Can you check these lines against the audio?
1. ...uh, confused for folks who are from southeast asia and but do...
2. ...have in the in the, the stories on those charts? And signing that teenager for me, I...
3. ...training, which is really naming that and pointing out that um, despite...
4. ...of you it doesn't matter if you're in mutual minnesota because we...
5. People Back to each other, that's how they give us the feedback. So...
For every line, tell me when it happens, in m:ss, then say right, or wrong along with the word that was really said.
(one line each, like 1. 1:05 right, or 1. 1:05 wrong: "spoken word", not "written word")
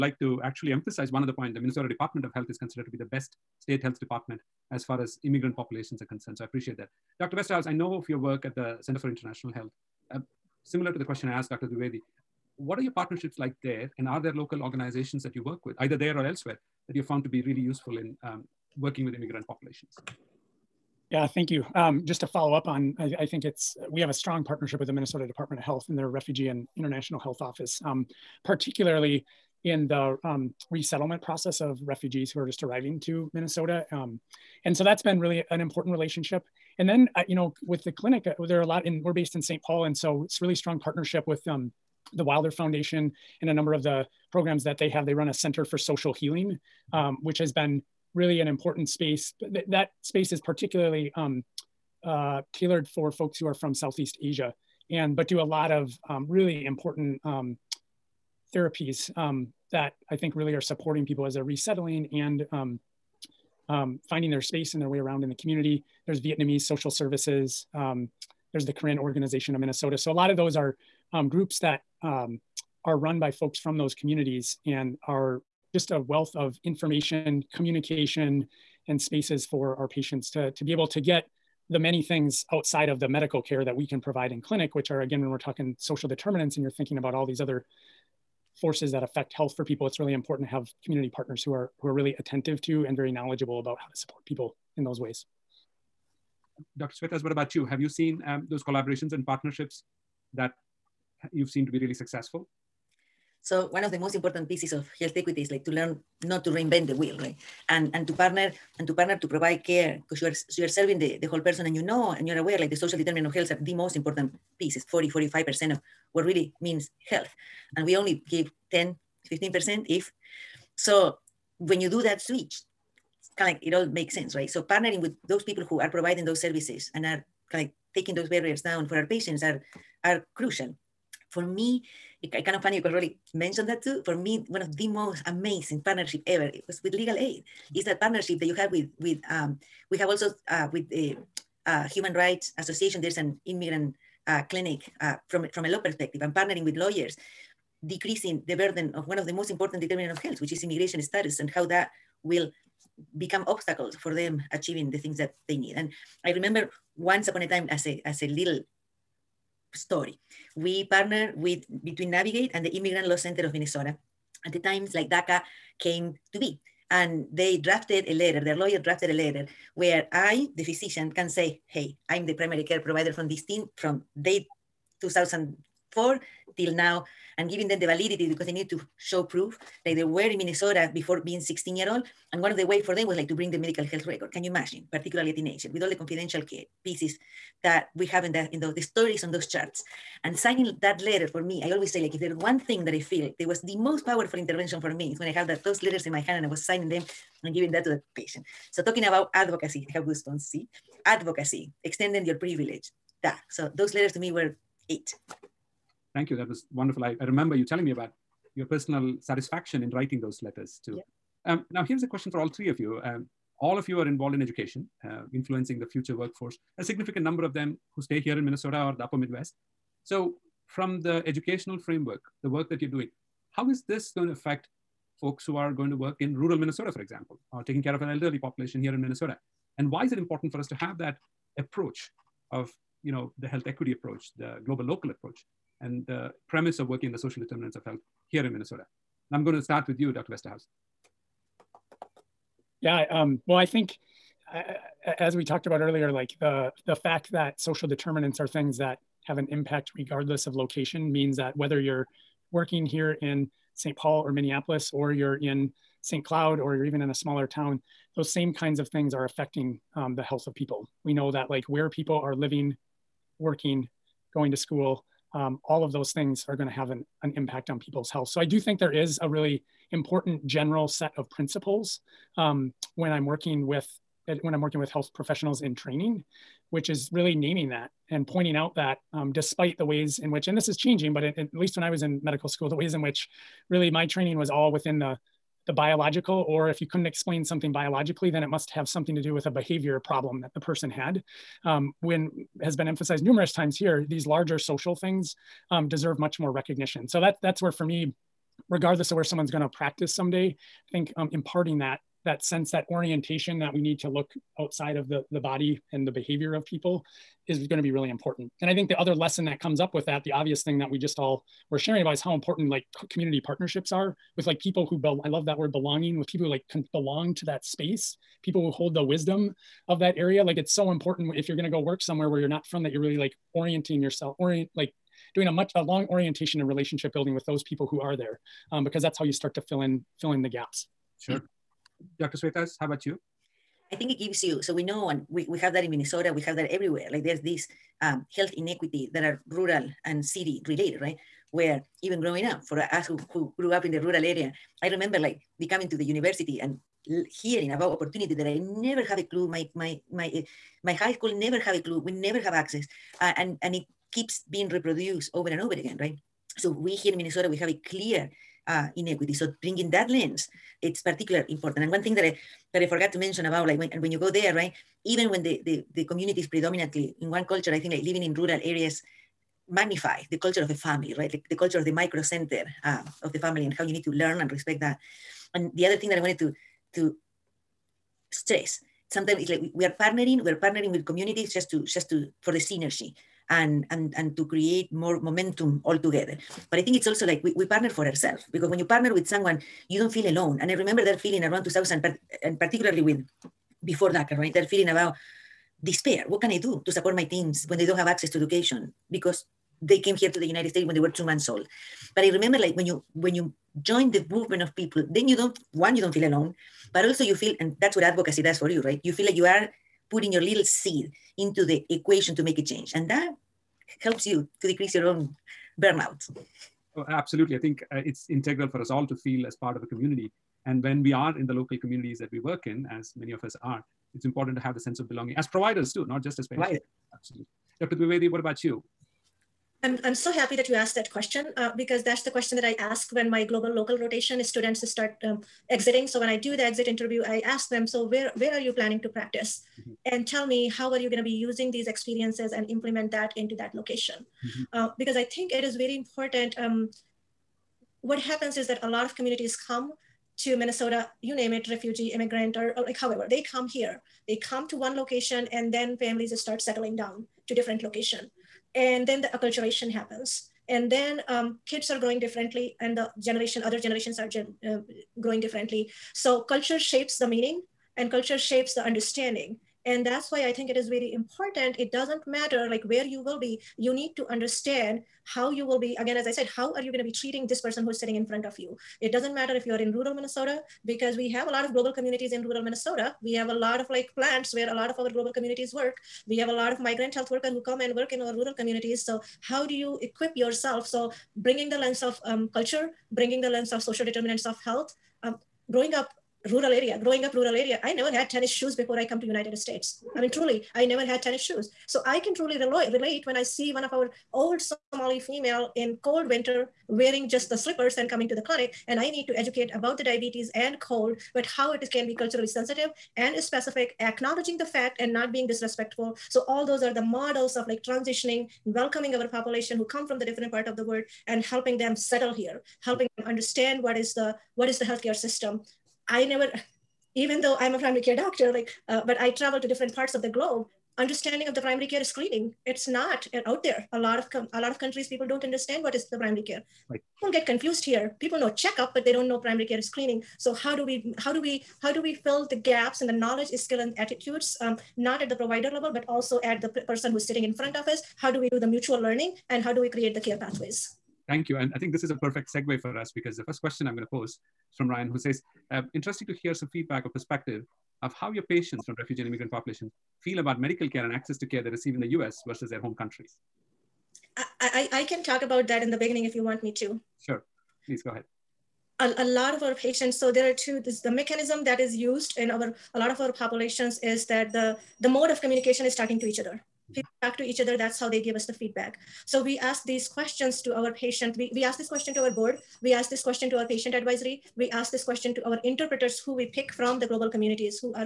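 1. 0:52 wrong: "tailored", not "confused"
2. 3:08 wrong: "letter", not "teenager"
3. 4:35 right
4. 7:58 wrong: "rural", not "mutual"
5. 9:36 right.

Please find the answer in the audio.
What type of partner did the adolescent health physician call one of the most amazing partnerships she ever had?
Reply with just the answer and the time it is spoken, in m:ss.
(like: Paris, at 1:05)
Legal aid, at 2:16.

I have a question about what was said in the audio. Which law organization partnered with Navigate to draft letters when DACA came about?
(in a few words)
Immigrant Law Center of Minnesota.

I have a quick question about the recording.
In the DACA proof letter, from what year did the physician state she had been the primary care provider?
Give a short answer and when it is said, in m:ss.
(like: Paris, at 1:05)
2004, at 2:55.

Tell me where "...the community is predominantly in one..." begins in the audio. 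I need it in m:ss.
6:05.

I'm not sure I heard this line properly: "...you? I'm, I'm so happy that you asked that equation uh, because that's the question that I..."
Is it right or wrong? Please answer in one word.
wrong.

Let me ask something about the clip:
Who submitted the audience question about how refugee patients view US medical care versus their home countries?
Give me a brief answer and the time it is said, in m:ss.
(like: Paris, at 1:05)
Ryan, at 9:14.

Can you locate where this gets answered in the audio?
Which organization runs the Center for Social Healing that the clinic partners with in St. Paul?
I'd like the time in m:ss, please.
0:42.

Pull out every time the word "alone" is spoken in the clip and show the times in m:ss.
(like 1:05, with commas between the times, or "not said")
6:30, 6:46.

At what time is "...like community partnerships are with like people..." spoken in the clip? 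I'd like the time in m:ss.
5:12.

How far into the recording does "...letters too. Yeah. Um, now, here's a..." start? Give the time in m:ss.
3:30.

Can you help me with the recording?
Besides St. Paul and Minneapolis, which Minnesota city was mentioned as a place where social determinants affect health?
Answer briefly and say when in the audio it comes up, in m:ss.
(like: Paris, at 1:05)
St. Cloud, at 4:16.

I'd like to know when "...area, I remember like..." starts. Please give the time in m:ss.
5:44.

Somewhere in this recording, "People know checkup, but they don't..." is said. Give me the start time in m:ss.
8:58.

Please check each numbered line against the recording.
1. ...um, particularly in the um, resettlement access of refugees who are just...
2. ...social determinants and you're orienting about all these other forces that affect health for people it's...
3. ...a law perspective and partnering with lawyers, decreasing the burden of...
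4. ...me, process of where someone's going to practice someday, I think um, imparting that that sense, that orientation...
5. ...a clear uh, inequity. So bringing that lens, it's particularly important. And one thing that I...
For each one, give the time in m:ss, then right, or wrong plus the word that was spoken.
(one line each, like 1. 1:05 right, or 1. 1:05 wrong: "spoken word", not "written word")
1. 0:27 wrong: "process", not "access"
2. 1:25 wrong: "thinking", not "orienting"
3. 2:25 right
4. 4:57 wrong: "regardless", not "process"
5. 5:57 right.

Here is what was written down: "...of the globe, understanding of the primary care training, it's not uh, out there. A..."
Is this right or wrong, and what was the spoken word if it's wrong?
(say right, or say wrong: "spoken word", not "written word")
wrong: "screening", not "training".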